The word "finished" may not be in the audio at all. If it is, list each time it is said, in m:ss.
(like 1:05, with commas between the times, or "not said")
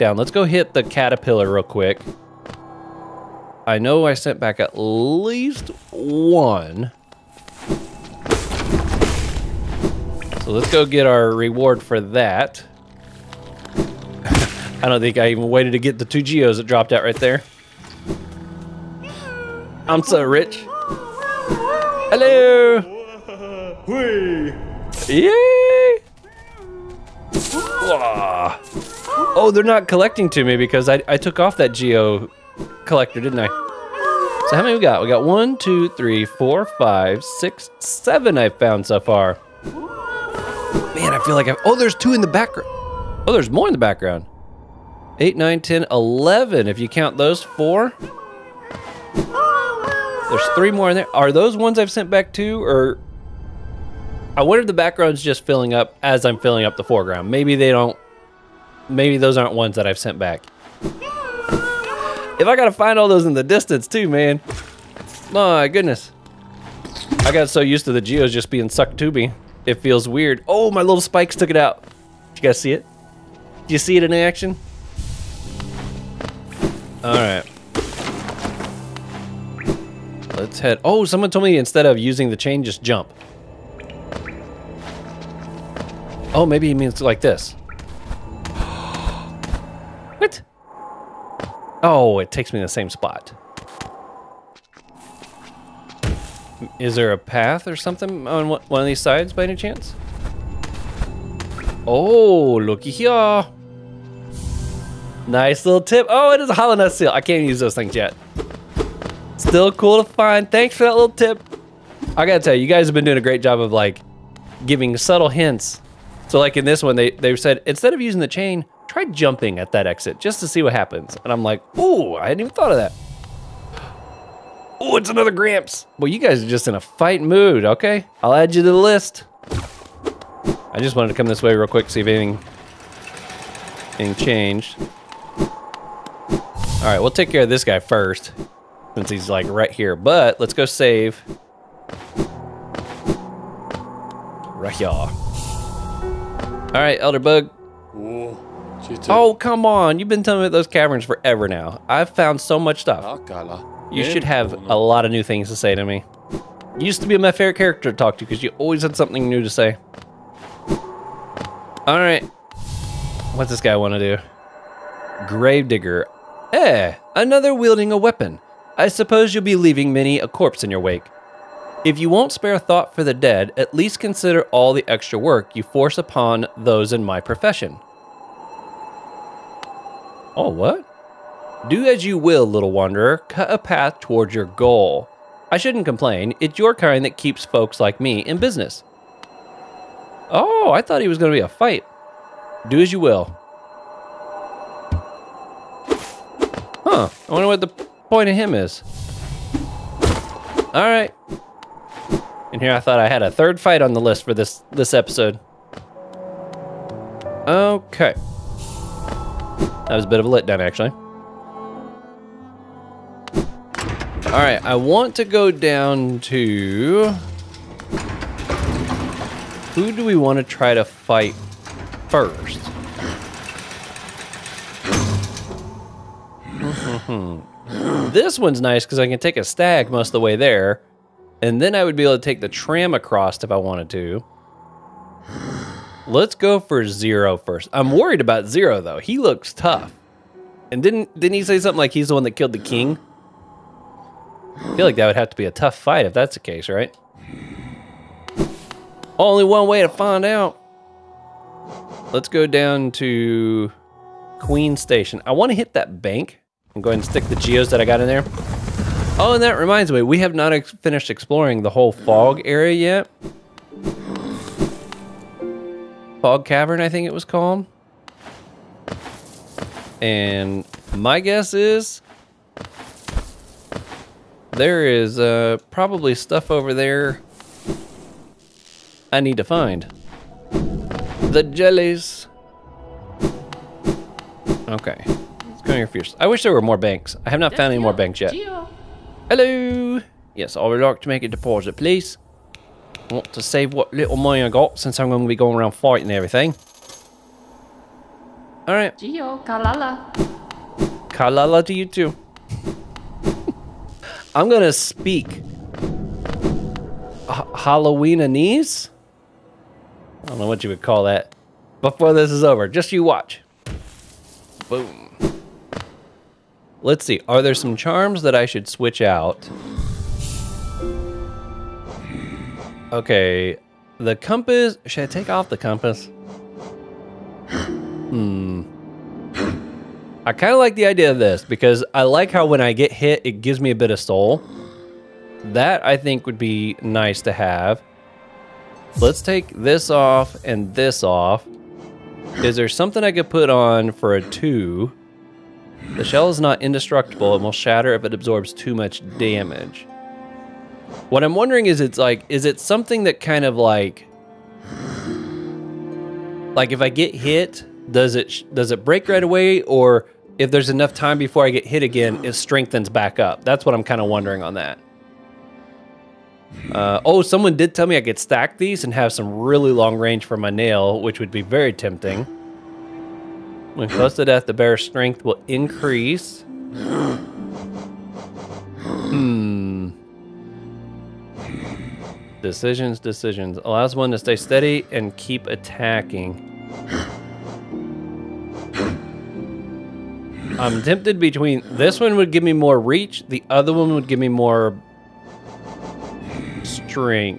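4:20.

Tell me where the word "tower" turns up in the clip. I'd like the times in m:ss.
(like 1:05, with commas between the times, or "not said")
not said.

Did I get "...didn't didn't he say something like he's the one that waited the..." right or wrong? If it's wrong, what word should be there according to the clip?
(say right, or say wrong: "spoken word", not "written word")
wrong: "killed", not "waited".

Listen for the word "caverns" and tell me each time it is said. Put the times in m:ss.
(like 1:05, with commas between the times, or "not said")
2:30, 4:26.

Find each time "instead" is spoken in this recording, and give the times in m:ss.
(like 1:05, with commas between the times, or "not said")
1:21, 1:57.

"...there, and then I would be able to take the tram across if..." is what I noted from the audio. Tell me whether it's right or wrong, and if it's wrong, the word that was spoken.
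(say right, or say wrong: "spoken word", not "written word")
right.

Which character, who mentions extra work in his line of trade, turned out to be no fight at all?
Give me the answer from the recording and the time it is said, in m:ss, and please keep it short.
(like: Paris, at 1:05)
Gravedigger, at 2:45.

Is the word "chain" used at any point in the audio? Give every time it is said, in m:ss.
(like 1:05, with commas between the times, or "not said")
1:22, 1:58.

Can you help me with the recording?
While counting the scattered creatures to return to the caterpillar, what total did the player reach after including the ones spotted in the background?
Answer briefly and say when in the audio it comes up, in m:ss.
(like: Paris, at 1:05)
11, at 0:45.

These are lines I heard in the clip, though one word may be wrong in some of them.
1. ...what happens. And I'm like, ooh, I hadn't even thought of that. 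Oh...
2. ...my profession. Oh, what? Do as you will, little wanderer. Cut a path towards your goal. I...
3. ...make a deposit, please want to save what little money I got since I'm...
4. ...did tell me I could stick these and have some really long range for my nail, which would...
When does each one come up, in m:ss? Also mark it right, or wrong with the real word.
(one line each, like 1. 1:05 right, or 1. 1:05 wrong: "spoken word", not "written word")
1. 2:00 right
2. 2:57 right
3. 4:51 right
4. 6:07 wrong: "stack", not "stick".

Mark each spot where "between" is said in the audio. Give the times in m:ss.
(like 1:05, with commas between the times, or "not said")
6:31.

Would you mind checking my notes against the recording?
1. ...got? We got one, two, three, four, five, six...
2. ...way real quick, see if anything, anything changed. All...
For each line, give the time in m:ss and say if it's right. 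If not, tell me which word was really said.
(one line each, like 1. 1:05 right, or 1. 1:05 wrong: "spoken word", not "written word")
1. 0:34 right
2. 2:11 right.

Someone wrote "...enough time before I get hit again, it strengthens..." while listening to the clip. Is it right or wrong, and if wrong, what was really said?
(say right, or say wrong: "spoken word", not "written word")
right.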